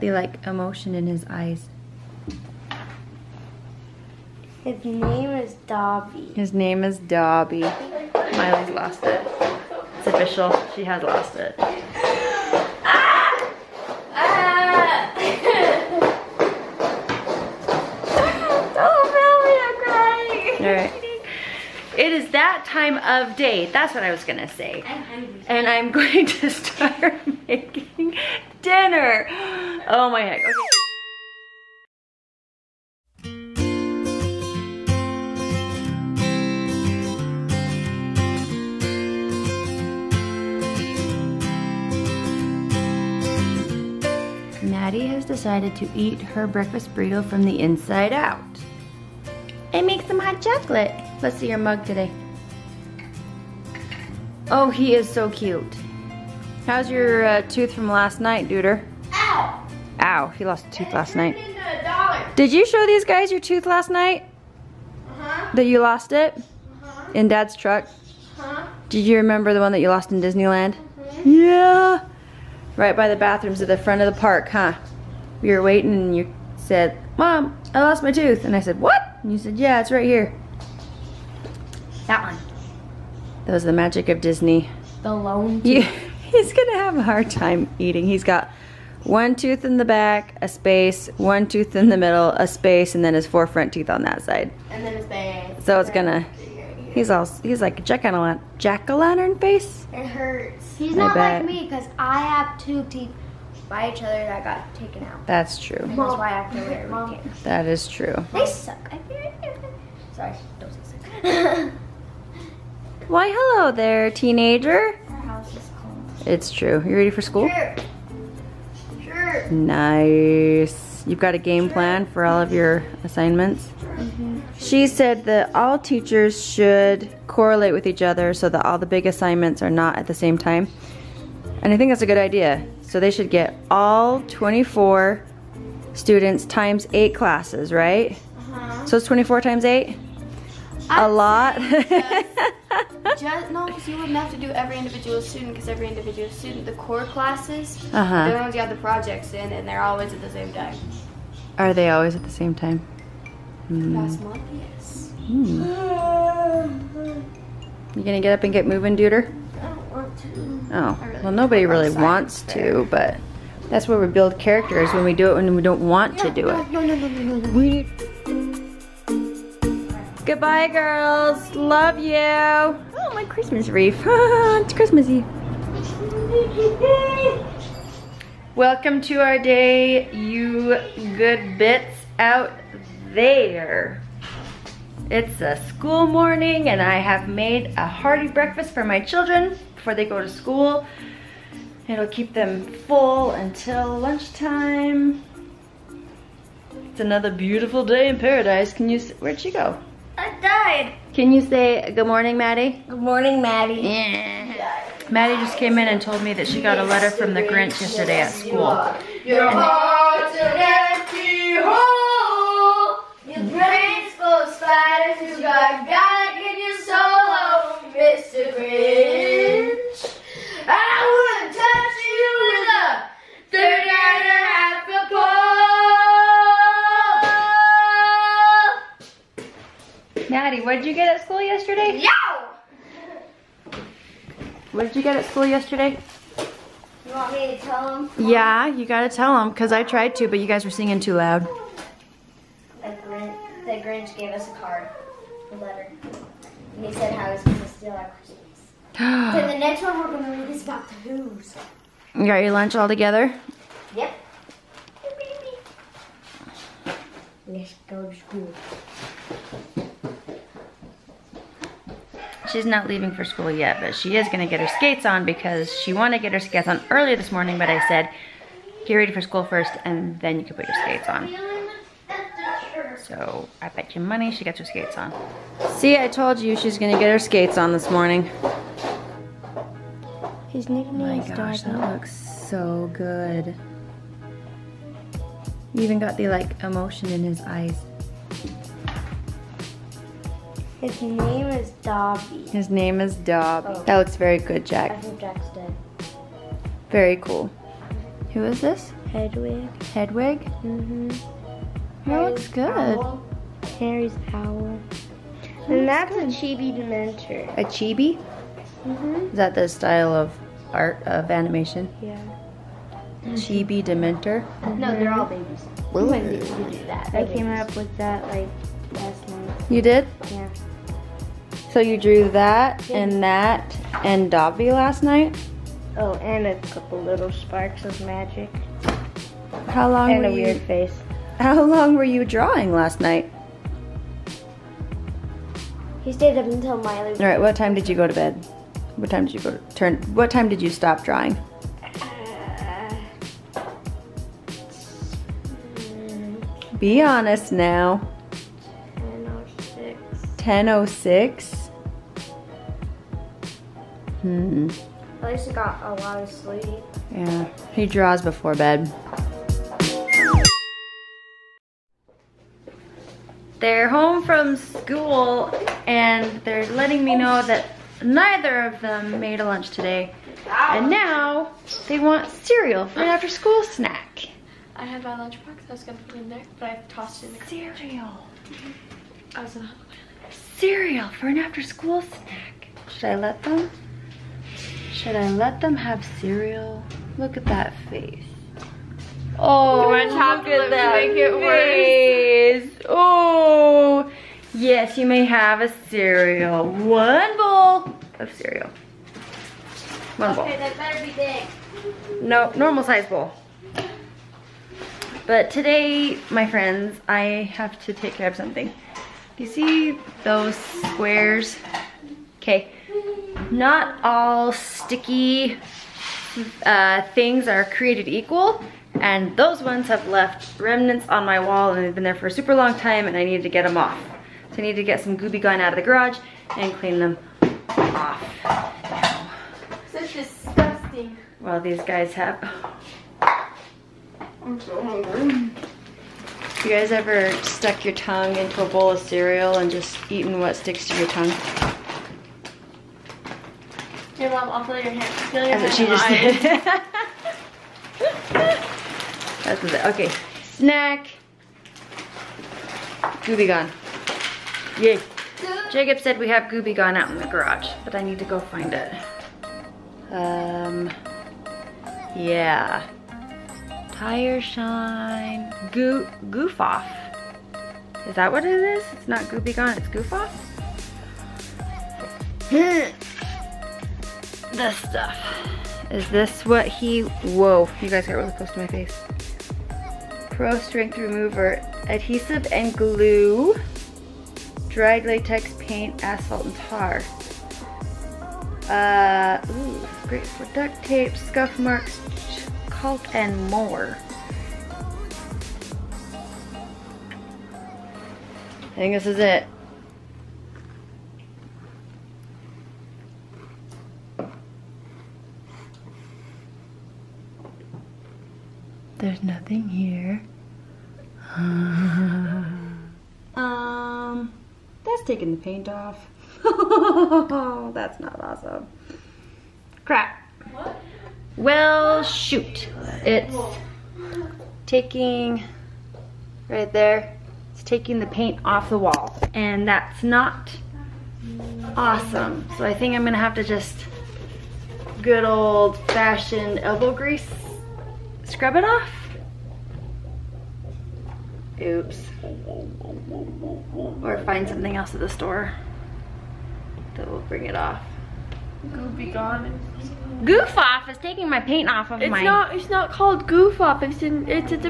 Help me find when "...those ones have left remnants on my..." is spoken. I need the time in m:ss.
6:59.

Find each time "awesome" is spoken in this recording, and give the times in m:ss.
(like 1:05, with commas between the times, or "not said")
8:38, 8:51.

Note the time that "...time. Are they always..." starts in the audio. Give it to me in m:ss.
2:30.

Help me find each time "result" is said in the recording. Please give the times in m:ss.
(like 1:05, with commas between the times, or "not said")
not said.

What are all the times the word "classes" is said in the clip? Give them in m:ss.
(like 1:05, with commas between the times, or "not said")
2:17, 2:27.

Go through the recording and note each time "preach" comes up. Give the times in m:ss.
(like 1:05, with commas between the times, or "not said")
not said.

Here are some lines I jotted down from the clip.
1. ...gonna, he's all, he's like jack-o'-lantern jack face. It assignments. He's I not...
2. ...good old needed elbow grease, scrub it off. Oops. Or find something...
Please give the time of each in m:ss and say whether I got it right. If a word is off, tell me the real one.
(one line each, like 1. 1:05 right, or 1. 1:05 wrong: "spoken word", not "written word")
1. 1:35 wrong: "hurts", not "assignments"
2. 8:54 wrong: "fashioned", not "needed".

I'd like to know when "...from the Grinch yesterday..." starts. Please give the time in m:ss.
3:27.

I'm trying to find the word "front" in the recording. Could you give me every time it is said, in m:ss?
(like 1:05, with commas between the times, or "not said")
1:13, 1:33.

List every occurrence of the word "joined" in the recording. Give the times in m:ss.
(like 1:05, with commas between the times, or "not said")
not said.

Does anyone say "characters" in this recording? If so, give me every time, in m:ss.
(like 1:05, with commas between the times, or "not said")
2:44.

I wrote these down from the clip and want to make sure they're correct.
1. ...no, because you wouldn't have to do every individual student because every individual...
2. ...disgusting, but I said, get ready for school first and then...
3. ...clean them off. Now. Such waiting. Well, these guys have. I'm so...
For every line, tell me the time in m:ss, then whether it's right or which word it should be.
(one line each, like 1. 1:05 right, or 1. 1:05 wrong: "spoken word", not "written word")
1. 2:23 right
2. 4:27 wrong: "morning", not "disgusting"
3. 7:06 wrong: "disgusting", not "waiting".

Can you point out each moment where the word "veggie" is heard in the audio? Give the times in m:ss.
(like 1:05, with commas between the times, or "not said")
not said.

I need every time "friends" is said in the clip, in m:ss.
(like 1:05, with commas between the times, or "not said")
6:46.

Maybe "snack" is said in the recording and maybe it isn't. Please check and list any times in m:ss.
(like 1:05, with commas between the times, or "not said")
6:13, 6:22, 7:30.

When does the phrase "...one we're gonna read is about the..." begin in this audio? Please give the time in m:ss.
4:09.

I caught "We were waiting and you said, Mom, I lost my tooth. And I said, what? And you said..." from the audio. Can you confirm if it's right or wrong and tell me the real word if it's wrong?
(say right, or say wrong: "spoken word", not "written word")
right.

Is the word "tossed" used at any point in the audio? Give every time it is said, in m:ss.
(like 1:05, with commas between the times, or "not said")
6:16.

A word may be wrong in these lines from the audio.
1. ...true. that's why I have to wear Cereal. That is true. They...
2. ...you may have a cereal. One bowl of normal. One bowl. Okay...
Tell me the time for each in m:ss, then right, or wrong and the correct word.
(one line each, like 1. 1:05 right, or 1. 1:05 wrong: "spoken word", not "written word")
1. 1:45 wrong: "Mom", not "Cereal"
2. 6:34 wrong: "cereal", not "normal".